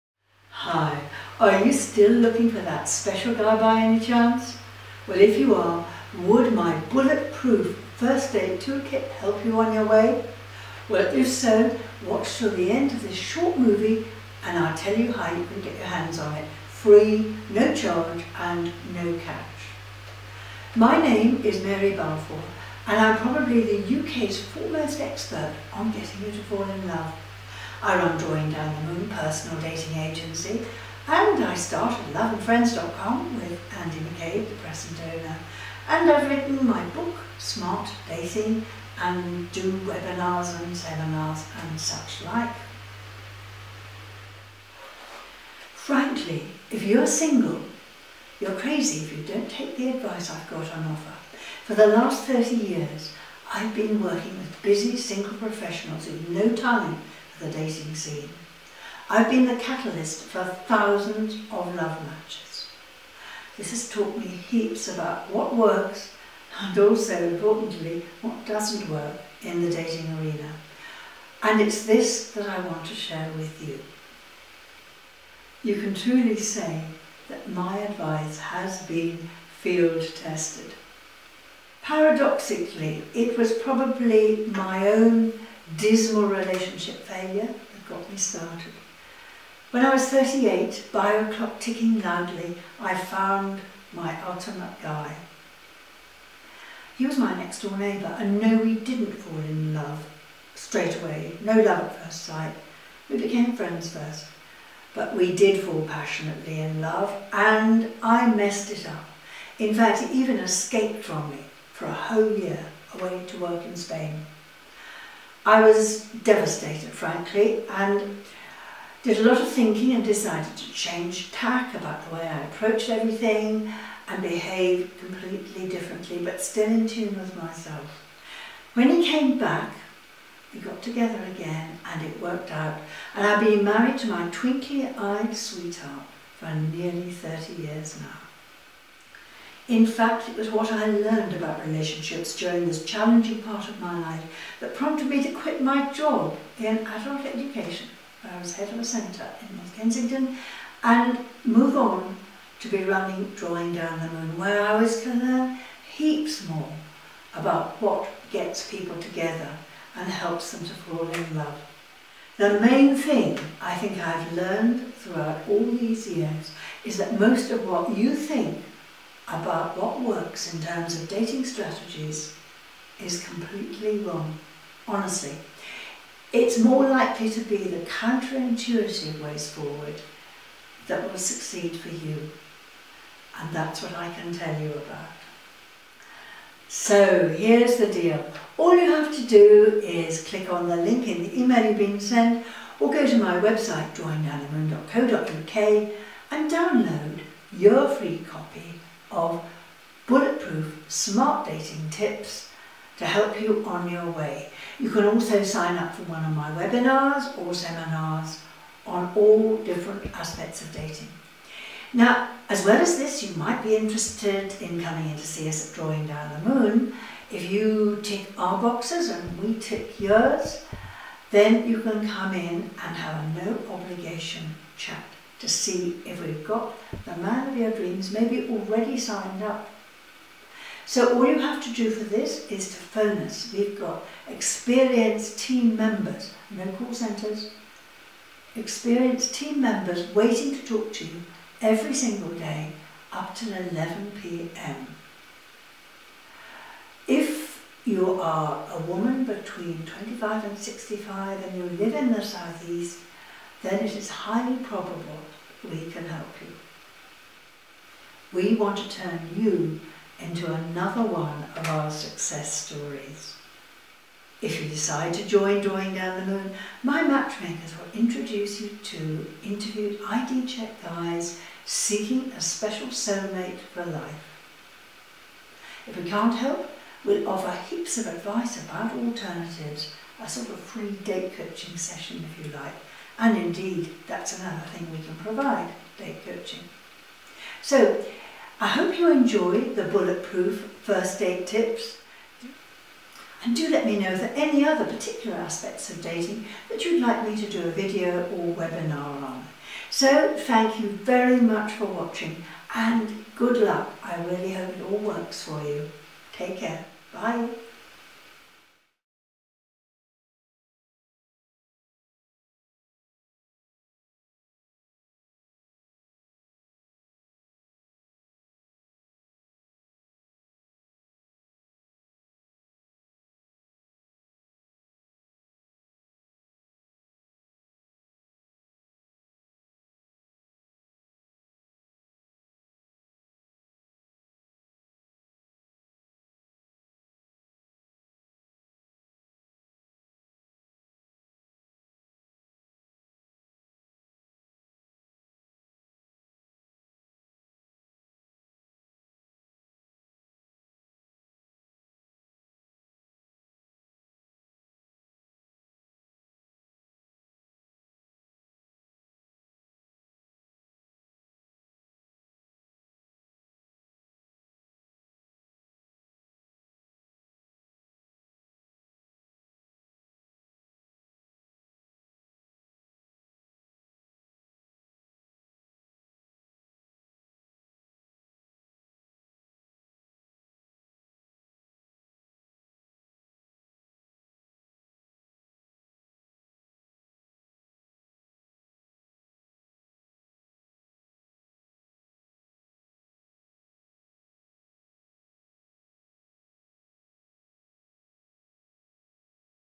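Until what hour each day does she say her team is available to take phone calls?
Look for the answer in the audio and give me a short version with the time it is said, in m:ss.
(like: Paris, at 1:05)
11 p.m., at 4:03.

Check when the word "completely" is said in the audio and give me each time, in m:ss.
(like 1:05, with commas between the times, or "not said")
2:04, 2:53.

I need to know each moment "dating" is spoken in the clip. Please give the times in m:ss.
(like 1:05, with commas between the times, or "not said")
0:29, 0:38, 0:57, 1:09, 2:51, 3:21, 3:30, 4:56.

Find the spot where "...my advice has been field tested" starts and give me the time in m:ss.
1:17.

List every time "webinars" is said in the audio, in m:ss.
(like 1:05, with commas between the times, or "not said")
0:39, 3:26, 4:58.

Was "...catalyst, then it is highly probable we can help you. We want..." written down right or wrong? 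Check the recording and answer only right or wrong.
wrong.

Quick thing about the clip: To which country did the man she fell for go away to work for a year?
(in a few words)
Spain.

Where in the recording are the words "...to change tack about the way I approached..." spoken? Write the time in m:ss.
2:00.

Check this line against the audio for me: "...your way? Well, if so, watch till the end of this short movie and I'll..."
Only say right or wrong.
right.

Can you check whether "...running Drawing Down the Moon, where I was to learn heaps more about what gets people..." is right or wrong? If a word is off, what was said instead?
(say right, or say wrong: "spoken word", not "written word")
right.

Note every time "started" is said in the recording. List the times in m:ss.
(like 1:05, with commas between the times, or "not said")
0:31, 1:28.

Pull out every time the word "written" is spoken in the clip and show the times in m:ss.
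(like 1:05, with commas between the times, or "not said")
0:36.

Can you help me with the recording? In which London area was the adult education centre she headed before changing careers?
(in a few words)
North Kensington.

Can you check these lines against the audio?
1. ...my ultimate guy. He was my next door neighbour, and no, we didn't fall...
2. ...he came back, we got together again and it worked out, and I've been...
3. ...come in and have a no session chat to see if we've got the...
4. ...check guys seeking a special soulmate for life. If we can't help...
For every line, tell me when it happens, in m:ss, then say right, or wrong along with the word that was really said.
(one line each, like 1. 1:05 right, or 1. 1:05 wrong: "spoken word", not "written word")
1. 1:33 right
2. 2:08 right
3. 3:42 wrong: "obligation", not "session"
4. 4:30 right.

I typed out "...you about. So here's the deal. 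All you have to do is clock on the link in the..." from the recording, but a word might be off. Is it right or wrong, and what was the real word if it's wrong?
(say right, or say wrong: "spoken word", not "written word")
wrong: "click", not "clock".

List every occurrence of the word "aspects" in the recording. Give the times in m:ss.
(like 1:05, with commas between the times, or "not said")
3:30, 4:55.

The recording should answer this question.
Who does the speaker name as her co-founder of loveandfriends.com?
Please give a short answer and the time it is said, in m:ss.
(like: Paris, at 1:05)
Andy McCabe, at 0:33.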